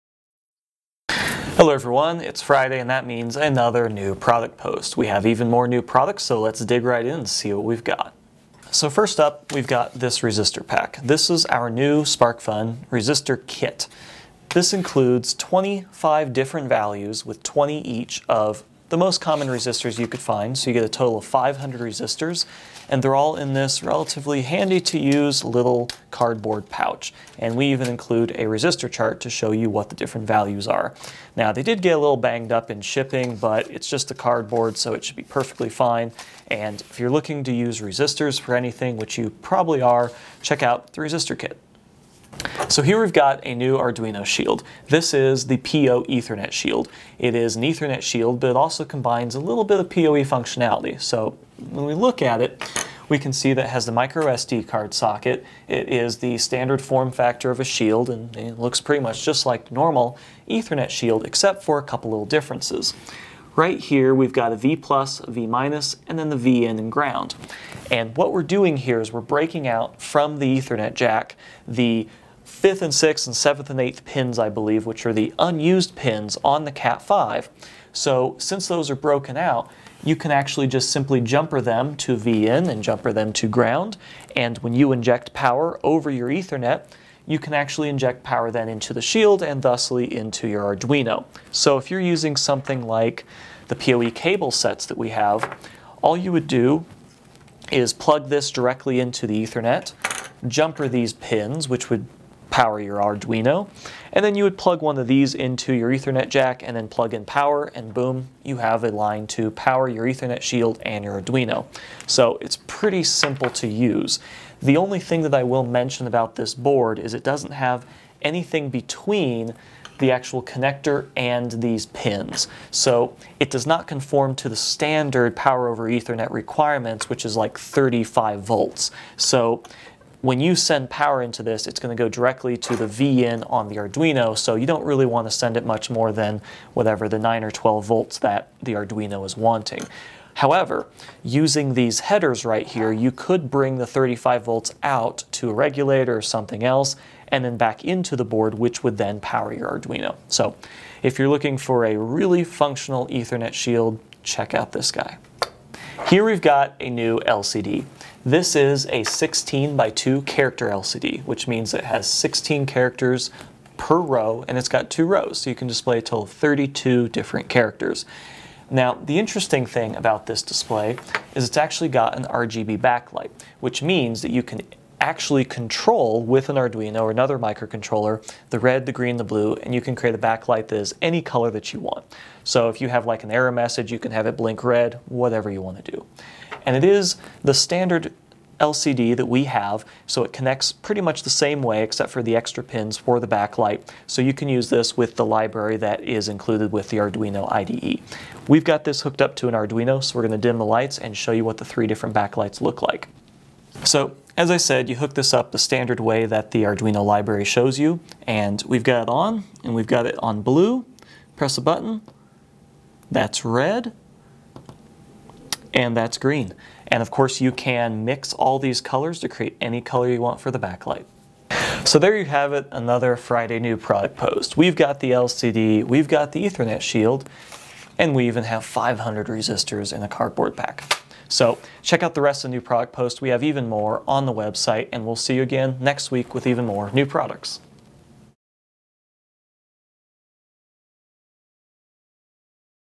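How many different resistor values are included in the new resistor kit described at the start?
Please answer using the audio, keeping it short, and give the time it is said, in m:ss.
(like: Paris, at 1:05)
25, at 0:15.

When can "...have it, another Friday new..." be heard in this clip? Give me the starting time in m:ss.
3:42.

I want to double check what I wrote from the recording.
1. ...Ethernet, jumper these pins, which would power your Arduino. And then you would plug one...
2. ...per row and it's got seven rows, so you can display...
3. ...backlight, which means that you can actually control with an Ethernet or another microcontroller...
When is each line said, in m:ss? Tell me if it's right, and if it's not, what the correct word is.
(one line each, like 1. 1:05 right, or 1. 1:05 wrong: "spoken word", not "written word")
1. 1:39 right
2. 2:43 wrong: "two", not "seven"
3. 2:52 wrong: "Arduino", not "Ethernet".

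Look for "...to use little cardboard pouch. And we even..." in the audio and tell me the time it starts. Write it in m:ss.
0:24.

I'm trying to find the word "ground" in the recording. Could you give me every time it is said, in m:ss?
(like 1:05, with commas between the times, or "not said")
1:06, 1:23.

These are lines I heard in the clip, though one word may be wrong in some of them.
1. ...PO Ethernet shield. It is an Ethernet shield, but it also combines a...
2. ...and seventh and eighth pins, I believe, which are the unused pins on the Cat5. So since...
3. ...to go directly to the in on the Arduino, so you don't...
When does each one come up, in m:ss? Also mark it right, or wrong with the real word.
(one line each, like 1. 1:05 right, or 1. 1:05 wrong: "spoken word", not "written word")
1. 0:45 right
2. 1:13 right
3. 2:11 right.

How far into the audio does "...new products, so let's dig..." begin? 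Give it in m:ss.
0:05.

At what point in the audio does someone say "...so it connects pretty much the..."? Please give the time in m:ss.
3:10.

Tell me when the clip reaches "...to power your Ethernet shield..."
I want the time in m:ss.
1:49.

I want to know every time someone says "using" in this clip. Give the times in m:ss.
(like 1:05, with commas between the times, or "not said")
1:31, 2:21.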